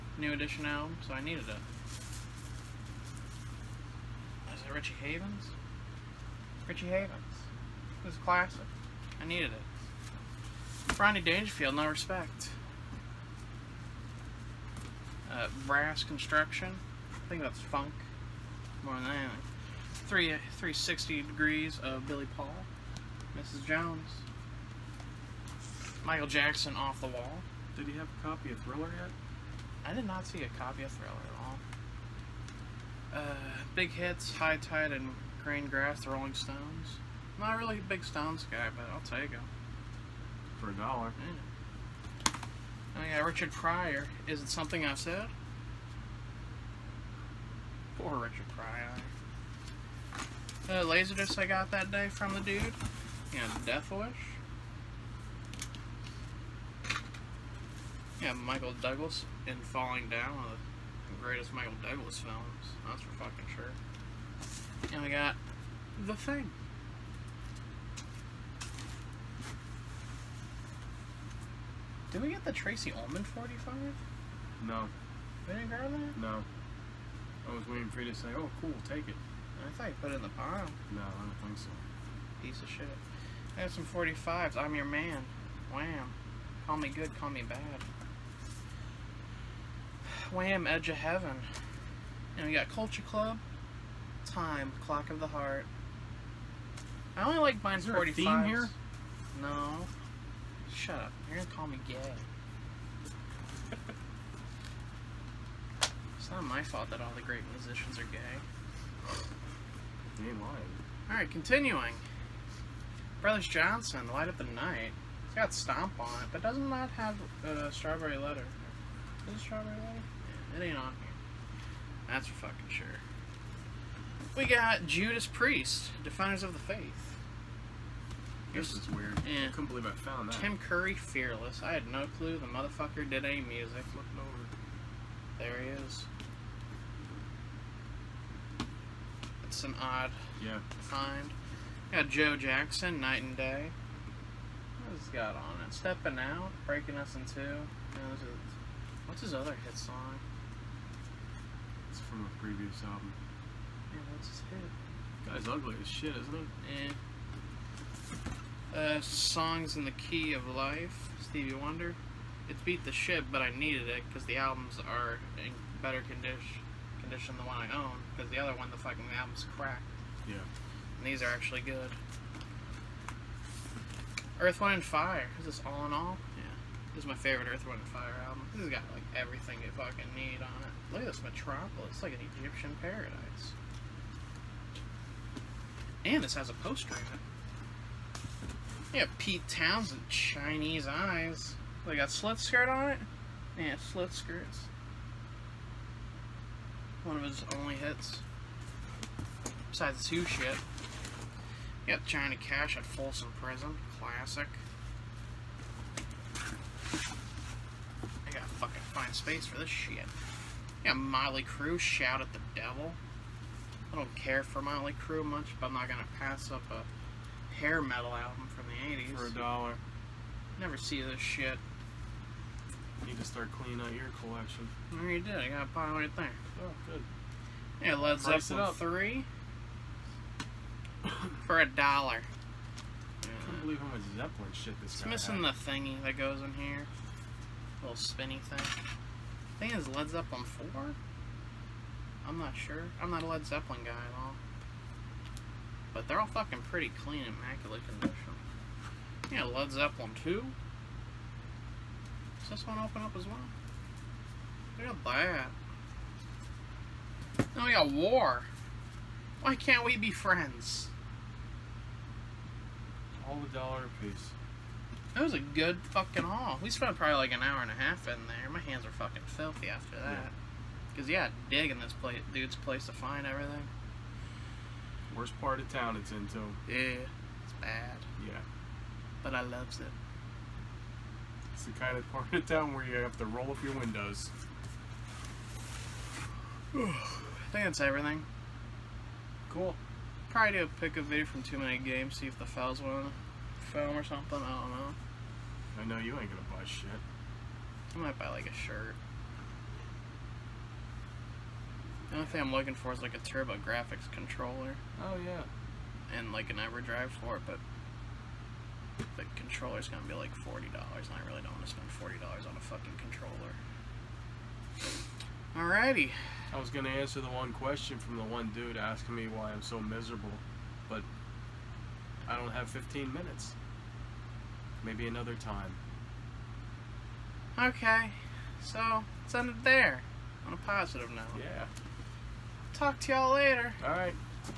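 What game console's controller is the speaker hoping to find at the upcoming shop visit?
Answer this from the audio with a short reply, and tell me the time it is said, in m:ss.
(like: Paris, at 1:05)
TurboGrafx, at 5:03.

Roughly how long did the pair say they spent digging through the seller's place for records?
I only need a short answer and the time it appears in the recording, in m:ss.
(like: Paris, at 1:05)
an hour and a half, at 4:27.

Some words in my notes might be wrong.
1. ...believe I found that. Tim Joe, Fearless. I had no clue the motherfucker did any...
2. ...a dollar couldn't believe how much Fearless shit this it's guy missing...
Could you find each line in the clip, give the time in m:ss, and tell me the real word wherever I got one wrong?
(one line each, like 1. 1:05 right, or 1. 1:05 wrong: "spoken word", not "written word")
1. 2:09 wrong: "Curry", not "Joe"
2. 3:51 wrong: "Zeppelin", not "Fearless".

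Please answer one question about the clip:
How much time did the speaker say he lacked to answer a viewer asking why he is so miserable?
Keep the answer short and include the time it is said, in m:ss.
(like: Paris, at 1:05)
15 minutes, at 5:22.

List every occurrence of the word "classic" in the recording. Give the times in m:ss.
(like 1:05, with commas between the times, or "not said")
0:08, 3:24.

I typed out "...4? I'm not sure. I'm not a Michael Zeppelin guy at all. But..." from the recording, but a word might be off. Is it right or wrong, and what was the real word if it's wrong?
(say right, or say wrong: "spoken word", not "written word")
wrong: "Led", not "Michael".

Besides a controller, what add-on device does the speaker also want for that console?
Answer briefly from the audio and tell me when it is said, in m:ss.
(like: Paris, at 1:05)
EverDrive, at 5:06.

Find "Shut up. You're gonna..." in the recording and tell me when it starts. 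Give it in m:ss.
1:40.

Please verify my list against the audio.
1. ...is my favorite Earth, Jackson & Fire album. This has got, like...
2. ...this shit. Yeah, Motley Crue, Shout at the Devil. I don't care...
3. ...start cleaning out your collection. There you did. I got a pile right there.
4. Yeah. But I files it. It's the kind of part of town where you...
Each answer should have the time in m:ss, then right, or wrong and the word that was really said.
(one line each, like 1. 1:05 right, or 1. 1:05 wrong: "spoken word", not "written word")
1. 2:57 wrong: "Wind", not "Jackson"
2. 3:29 right
3. 3:43 right
4. 4:38 wrong: "loves", not "files".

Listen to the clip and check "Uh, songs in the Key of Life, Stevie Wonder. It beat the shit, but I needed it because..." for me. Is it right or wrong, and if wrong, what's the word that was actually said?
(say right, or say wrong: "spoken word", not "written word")
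right.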